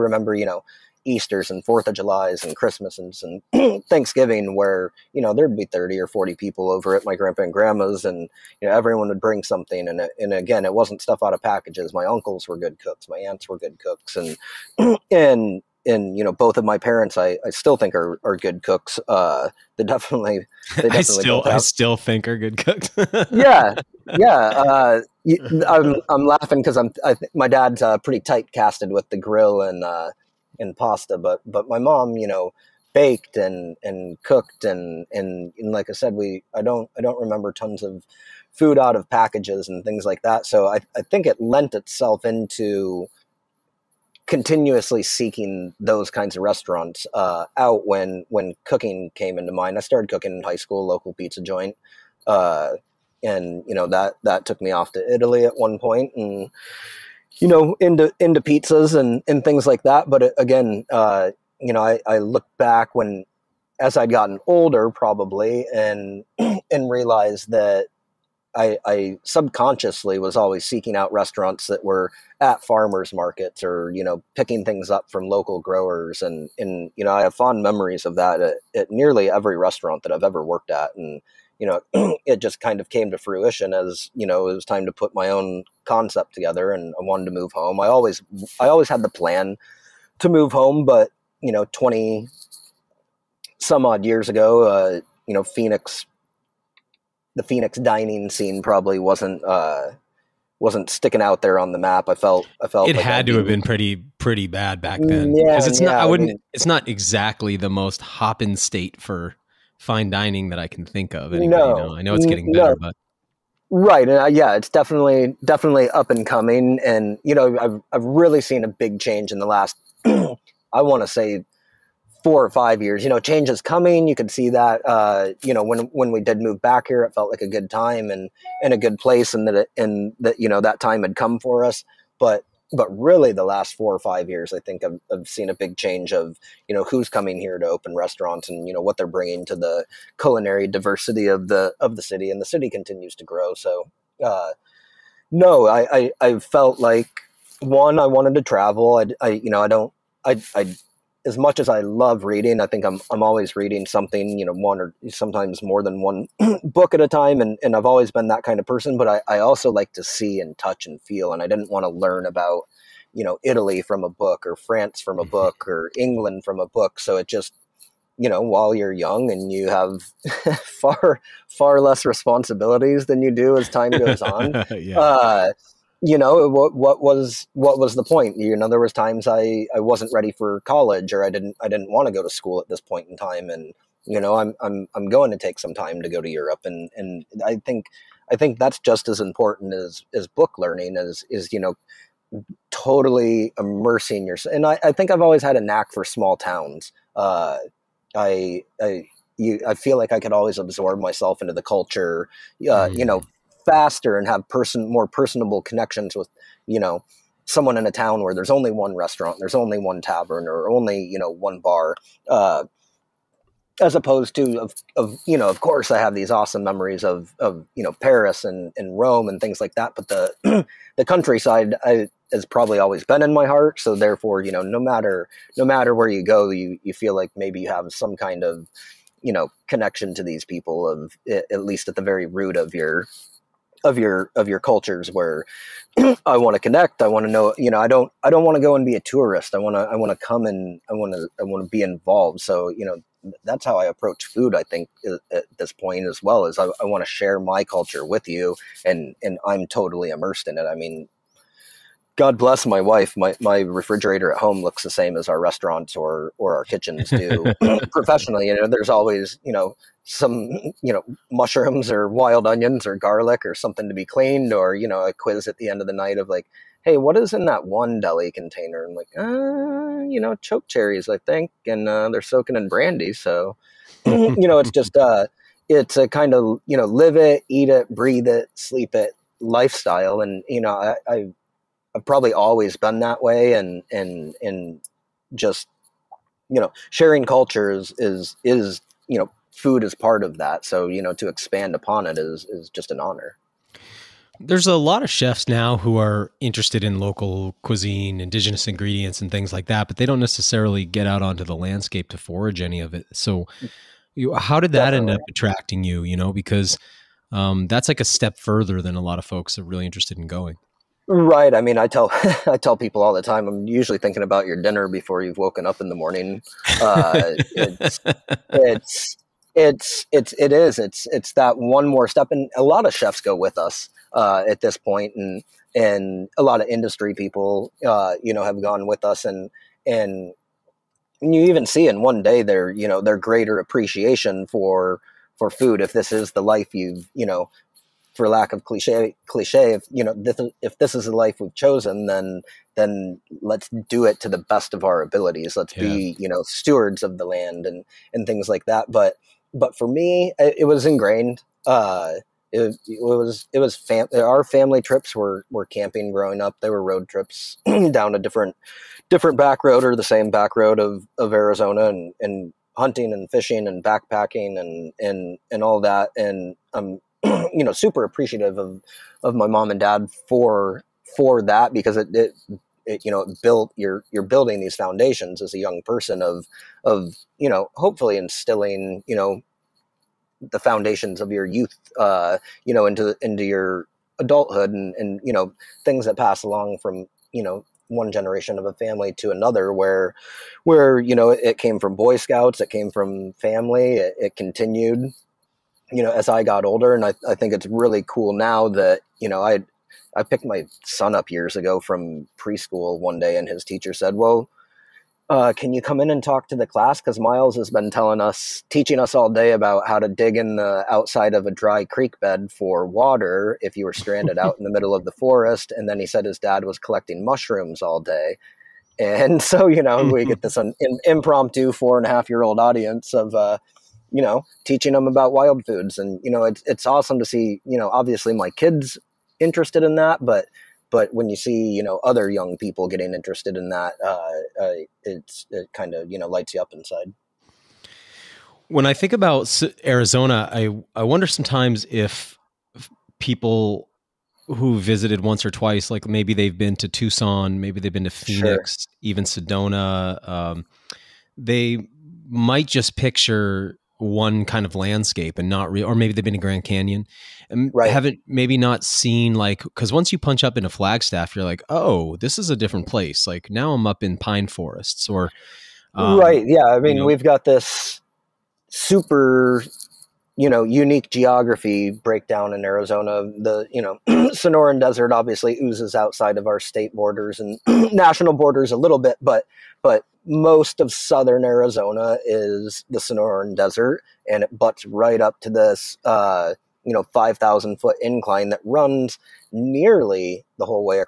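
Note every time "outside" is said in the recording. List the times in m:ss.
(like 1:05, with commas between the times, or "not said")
6:50, 7:55.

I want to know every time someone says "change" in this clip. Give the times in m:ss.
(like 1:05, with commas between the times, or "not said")
1:58, 2:03, 2:15.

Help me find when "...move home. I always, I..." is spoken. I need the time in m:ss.
1:27.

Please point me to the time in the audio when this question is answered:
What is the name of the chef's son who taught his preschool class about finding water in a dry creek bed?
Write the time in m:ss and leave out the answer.
6:47.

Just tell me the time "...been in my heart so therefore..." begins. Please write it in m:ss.
3:43.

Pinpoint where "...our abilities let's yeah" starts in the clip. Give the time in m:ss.
5:44.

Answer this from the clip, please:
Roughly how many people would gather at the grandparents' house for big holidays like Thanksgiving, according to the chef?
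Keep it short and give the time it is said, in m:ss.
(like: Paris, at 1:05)
30 or 40, at 0:05.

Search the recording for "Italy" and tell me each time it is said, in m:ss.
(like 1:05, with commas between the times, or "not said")
0:55, 2:43.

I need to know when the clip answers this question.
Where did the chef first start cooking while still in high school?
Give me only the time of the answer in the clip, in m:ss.
0:50.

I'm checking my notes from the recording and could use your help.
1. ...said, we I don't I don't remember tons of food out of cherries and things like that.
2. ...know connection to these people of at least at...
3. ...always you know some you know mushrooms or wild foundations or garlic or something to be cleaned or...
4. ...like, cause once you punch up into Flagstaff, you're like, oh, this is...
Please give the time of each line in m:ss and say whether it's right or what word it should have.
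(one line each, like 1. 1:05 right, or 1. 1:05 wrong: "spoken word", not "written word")
1. 0:35 wrong: "packages", not "cherries"
2. 3:49 right
3. 4:18 wrong: "onions", not "foundations"
4. 7:39 right.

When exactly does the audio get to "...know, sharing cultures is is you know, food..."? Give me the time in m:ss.
4:46.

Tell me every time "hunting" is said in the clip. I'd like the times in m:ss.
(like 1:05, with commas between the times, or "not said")
6:02.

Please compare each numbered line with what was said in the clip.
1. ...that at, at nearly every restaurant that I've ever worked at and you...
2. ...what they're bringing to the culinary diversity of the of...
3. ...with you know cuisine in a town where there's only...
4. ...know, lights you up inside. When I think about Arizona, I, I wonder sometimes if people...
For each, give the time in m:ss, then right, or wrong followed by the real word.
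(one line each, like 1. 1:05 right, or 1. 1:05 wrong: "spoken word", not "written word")
1. 1:18 right
2. 2:18 right
3. 3:26 wrong: "someone", not "cuisine"
4. 7:16 right.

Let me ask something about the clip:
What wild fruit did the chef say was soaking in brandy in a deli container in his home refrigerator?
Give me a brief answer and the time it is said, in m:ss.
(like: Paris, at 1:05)
Choke cherries, at 4:30.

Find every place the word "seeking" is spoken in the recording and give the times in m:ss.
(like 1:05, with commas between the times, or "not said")
0:45, 1:10.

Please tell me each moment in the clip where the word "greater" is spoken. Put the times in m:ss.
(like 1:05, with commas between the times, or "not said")
5:33.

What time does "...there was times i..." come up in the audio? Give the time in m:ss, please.
2:58.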